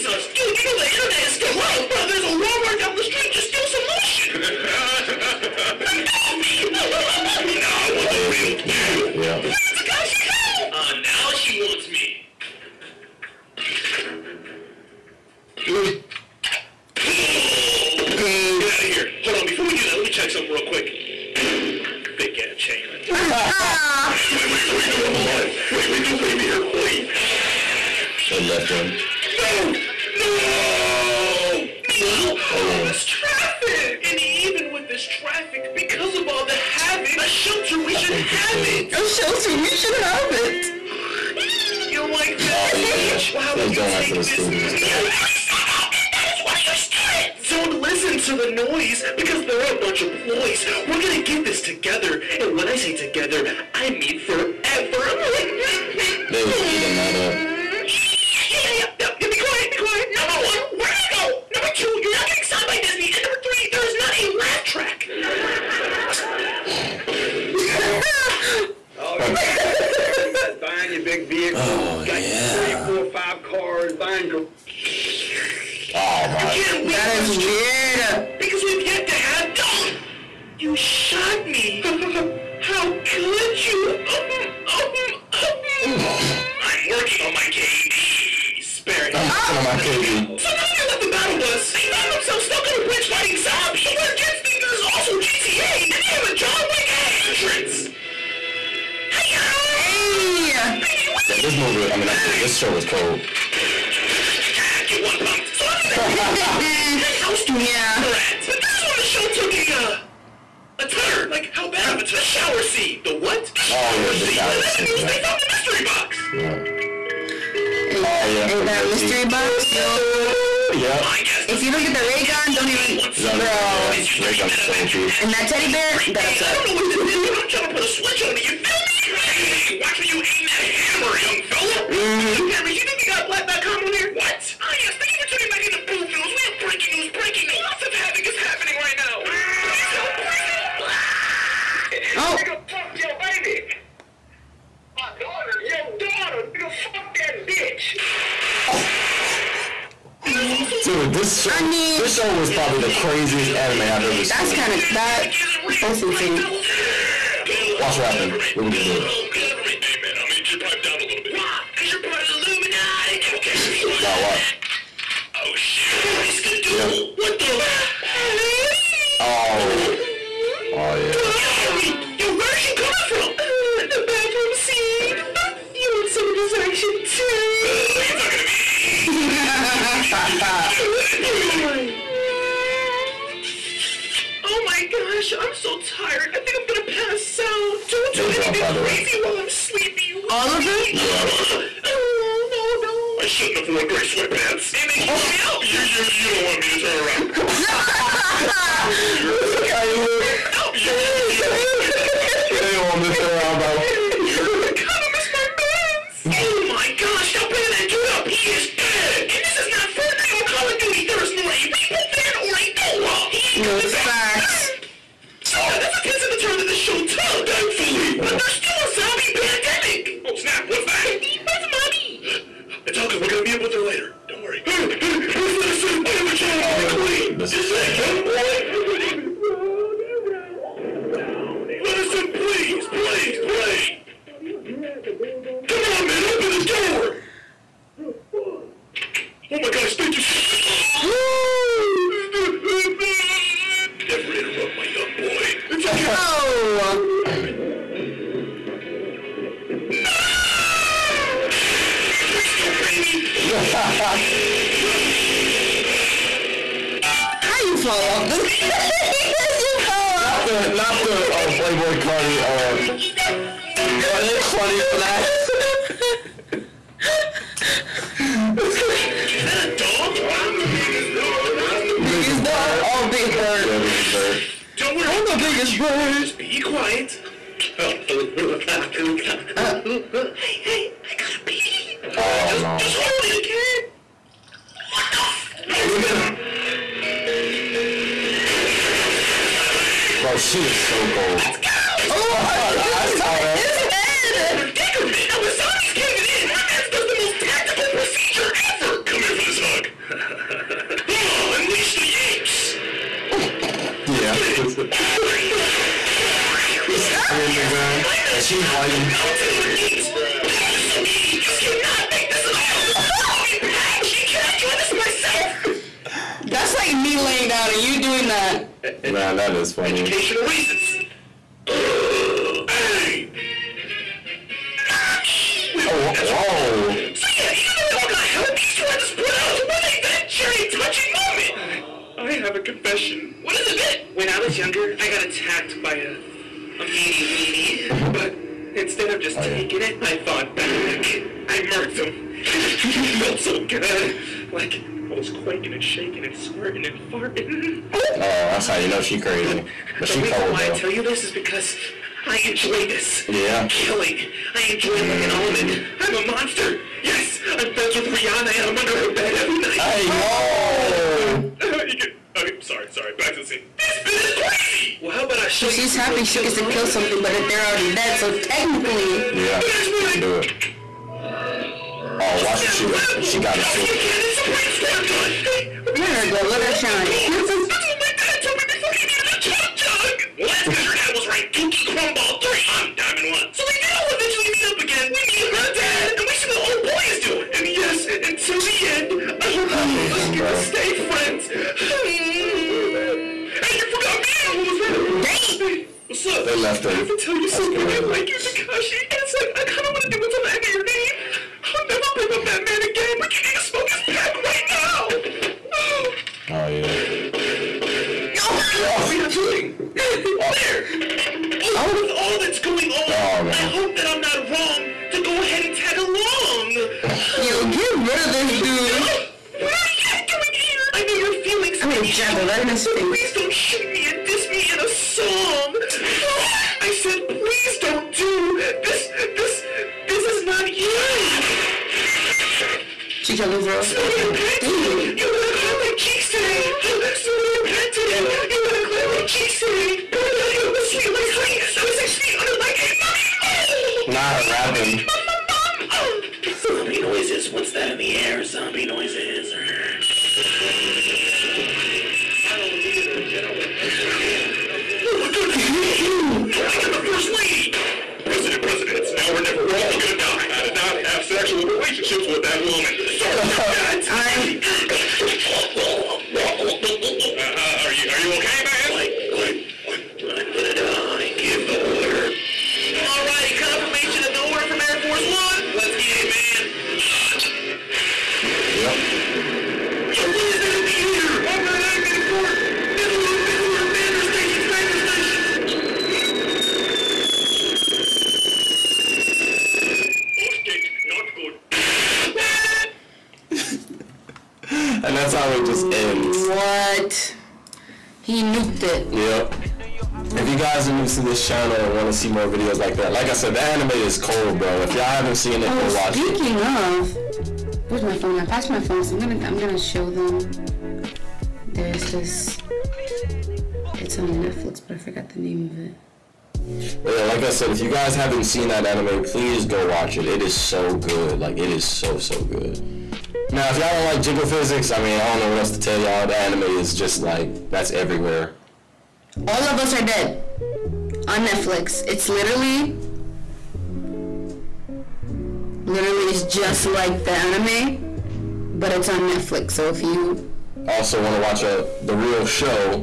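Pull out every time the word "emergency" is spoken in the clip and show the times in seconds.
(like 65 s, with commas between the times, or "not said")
not said.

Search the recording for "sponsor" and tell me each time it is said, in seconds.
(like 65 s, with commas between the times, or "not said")
not said.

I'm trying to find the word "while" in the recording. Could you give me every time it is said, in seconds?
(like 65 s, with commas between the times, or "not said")
189 s.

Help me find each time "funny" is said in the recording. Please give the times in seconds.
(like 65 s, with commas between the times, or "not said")
264 s, 319 s.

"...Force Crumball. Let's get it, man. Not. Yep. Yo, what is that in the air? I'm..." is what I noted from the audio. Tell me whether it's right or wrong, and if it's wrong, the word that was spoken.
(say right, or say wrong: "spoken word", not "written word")
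wrong: "One", not "Crumball".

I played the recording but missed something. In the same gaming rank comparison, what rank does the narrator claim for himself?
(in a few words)
Diamond 1.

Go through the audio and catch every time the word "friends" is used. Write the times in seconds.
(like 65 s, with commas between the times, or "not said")
357 s, 390 s.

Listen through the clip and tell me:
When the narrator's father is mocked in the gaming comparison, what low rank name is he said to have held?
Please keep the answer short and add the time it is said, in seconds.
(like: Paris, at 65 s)
Dookie Crumball 3, at 381 s.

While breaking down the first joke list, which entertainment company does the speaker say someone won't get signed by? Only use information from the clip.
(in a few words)
Disney.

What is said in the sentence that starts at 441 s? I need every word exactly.
I was six feet under like a mummy.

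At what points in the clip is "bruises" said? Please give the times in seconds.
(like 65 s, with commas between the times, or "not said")
not said.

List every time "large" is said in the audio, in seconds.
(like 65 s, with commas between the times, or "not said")
not said.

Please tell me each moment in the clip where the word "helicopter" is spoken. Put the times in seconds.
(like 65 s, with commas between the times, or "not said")
not said.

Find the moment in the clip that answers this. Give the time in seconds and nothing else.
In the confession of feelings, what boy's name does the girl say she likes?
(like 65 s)
398 s.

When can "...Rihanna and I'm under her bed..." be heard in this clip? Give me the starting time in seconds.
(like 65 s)
358 s.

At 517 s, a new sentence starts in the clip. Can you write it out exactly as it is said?
But yeah, like I said, if you guys haven't seen that anime, please go watch it.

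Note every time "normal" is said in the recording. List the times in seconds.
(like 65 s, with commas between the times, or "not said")
not said.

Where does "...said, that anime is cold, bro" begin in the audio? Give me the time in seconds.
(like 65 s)
503 s.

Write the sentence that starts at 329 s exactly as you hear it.
So were they then sharing touching moment?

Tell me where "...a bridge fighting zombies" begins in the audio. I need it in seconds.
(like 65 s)
92 s.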